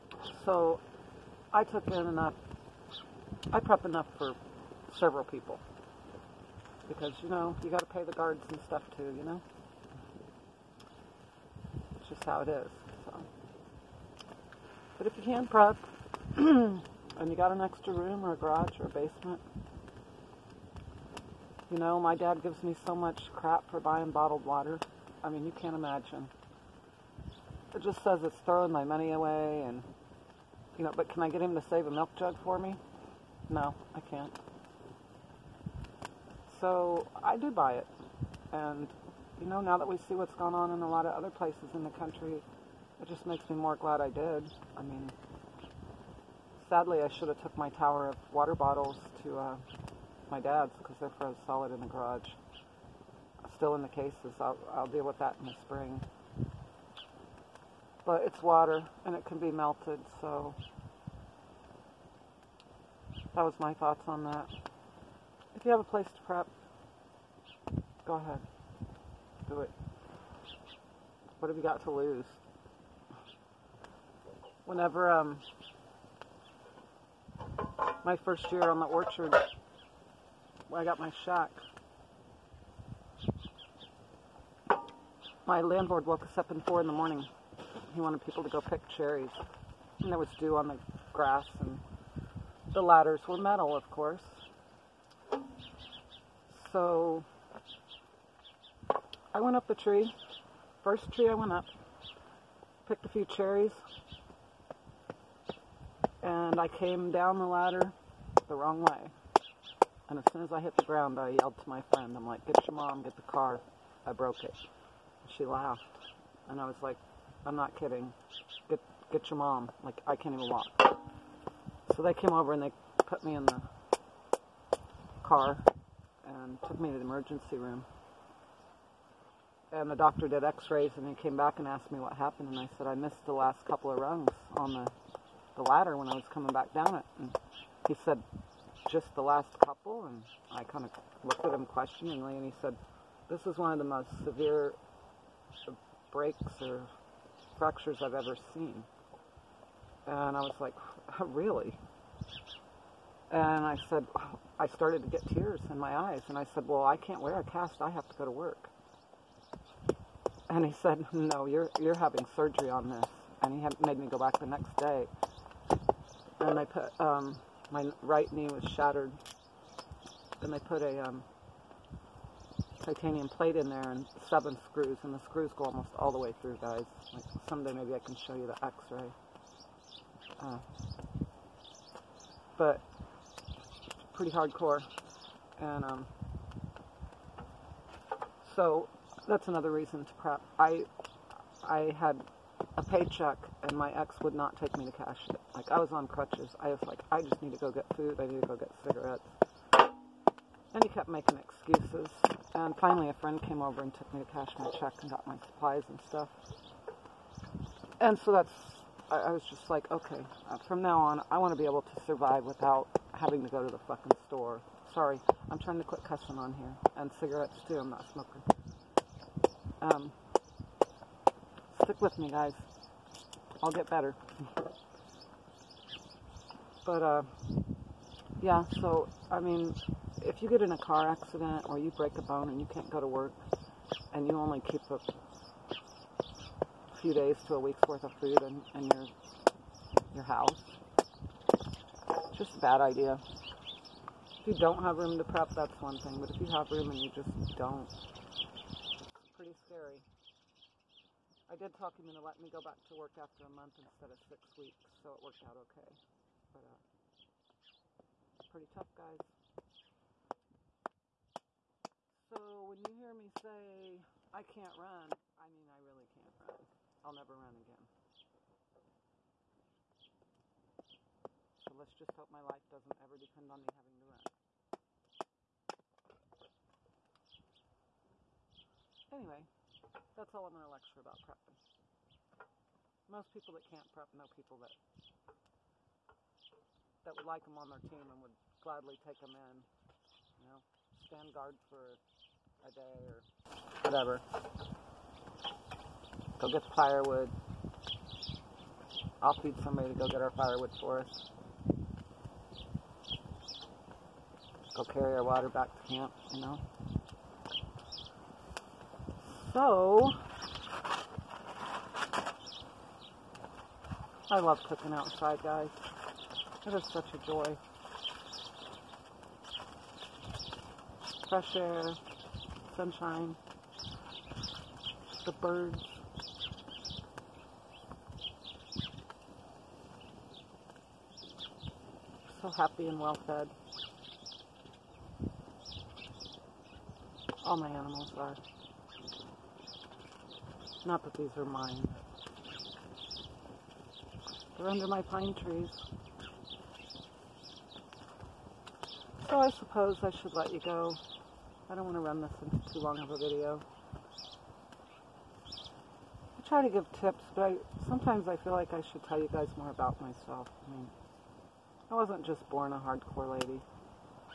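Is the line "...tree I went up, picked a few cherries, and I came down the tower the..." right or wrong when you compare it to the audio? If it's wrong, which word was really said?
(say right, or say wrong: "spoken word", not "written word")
wrong: "ladder", not "tower".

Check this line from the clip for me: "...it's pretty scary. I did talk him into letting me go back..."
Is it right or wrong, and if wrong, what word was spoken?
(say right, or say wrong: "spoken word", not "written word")
right.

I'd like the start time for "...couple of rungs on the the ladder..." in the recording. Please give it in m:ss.
2:13.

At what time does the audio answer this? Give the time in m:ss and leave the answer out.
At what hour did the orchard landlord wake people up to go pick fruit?
1:26.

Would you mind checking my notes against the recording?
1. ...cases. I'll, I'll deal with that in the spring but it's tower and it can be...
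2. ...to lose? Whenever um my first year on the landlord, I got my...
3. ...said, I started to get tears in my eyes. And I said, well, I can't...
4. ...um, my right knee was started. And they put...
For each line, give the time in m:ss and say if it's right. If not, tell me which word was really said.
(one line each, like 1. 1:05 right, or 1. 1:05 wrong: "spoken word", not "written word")
1. 0:53 wrong: "water", not "tower"
2. 1:11 wrong: "orchard", not "landlord"
3. 2:33 right
4. 2:46 wrong: "shattered", not "started".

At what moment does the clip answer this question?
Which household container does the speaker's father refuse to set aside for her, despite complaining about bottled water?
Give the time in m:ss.
0:31.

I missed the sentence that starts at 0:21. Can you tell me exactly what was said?
You know, my dad gives me so much crap for buying bottled water.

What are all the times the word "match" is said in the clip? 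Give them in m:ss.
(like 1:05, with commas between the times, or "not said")
not said.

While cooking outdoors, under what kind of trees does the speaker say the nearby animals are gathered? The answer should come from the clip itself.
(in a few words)
pine trees.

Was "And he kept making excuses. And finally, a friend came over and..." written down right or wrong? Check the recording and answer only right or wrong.
right.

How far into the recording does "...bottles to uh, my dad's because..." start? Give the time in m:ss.
0:48.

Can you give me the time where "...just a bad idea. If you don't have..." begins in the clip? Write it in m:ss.
4:02.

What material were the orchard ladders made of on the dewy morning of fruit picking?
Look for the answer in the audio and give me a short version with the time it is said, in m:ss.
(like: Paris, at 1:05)
metal, at 1:33.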